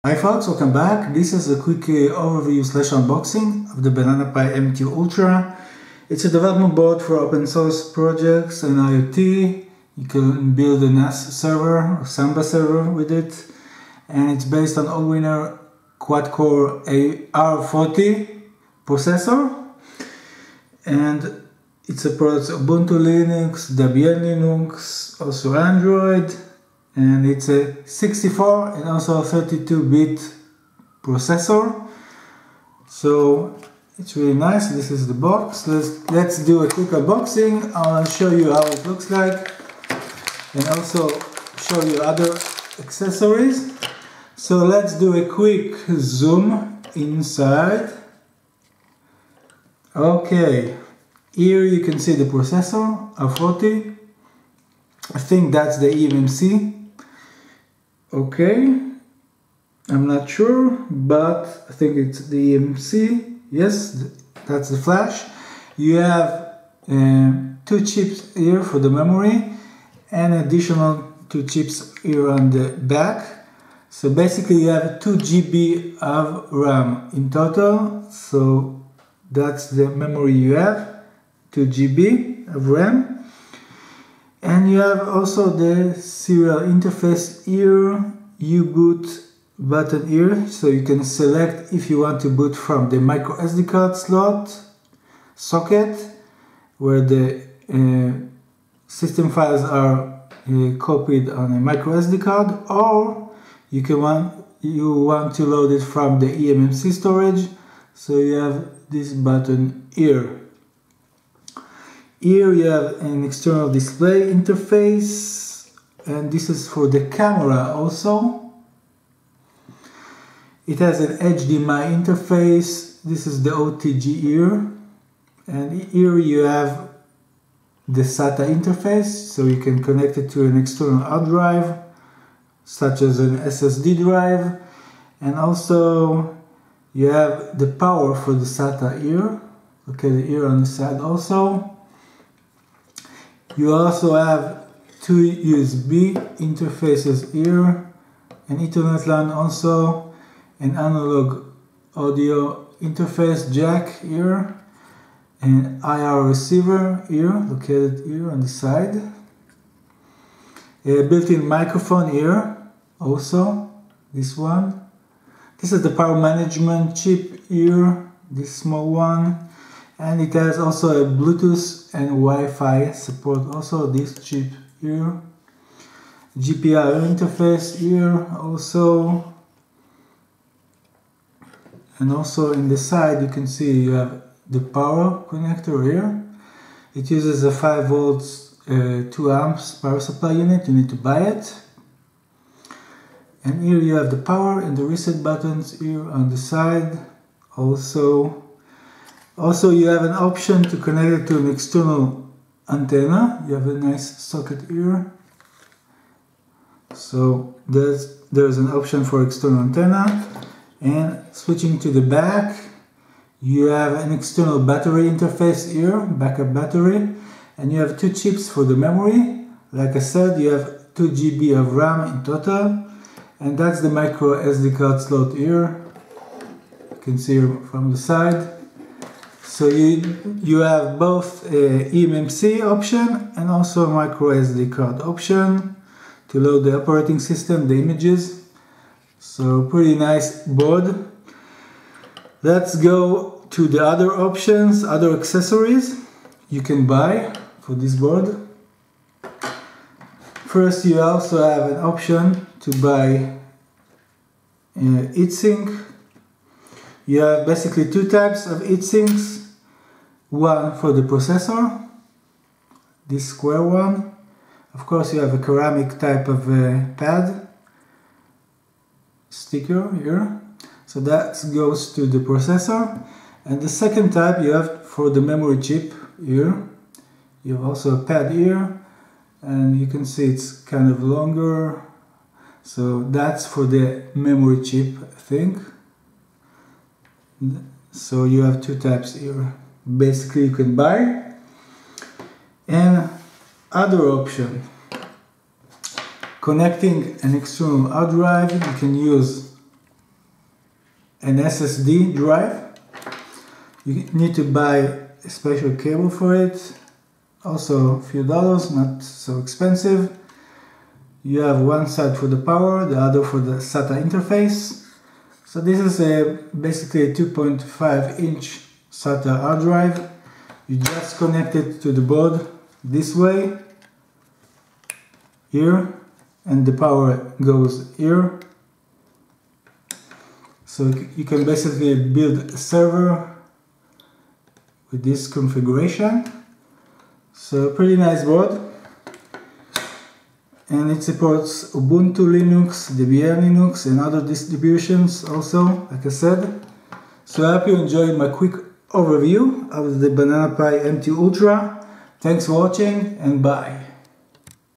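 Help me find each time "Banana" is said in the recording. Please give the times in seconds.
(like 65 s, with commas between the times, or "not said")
3 s, 350 s.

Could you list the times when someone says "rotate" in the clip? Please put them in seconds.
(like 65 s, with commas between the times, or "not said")
not said.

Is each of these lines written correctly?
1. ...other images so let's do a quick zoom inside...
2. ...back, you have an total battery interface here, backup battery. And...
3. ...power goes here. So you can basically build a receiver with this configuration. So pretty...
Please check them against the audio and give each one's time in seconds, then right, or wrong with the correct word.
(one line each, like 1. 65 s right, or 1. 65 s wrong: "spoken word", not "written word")
1. 42 s wrong: "accessories", not "images"
2. 212 s wrong: "external", not "total"
3. 326 s wrong: "server", not "receiver".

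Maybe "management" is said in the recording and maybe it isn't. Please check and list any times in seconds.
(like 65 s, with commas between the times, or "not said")
166 s.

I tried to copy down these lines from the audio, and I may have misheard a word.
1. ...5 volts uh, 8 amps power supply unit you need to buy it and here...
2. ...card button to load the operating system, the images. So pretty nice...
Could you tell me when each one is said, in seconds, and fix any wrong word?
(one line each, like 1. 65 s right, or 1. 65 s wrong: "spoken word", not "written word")
1. 187 s wrong: "2", not "8"
2. 234 s wrong: "option", not "button".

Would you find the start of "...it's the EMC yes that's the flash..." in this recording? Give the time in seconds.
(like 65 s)
61 s.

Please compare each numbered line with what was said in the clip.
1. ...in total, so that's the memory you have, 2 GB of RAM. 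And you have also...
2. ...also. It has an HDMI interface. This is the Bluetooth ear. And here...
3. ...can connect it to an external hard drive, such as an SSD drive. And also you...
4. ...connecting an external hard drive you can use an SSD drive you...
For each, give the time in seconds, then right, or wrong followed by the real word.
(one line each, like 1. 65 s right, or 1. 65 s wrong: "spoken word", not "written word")
1. 77 s right
2. 117 s wrong: "OTG", not "Bluetooth"
3. 129 s right
4. 296 s right.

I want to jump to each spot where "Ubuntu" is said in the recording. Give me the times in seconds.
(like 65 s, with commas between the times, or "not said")
22 s, 341 s.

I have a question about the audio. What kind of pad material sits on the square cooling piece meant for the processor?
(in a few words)
ceramic.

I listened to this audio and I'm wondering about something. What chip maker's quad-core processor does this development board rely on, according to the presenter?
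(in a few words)
Allwinner.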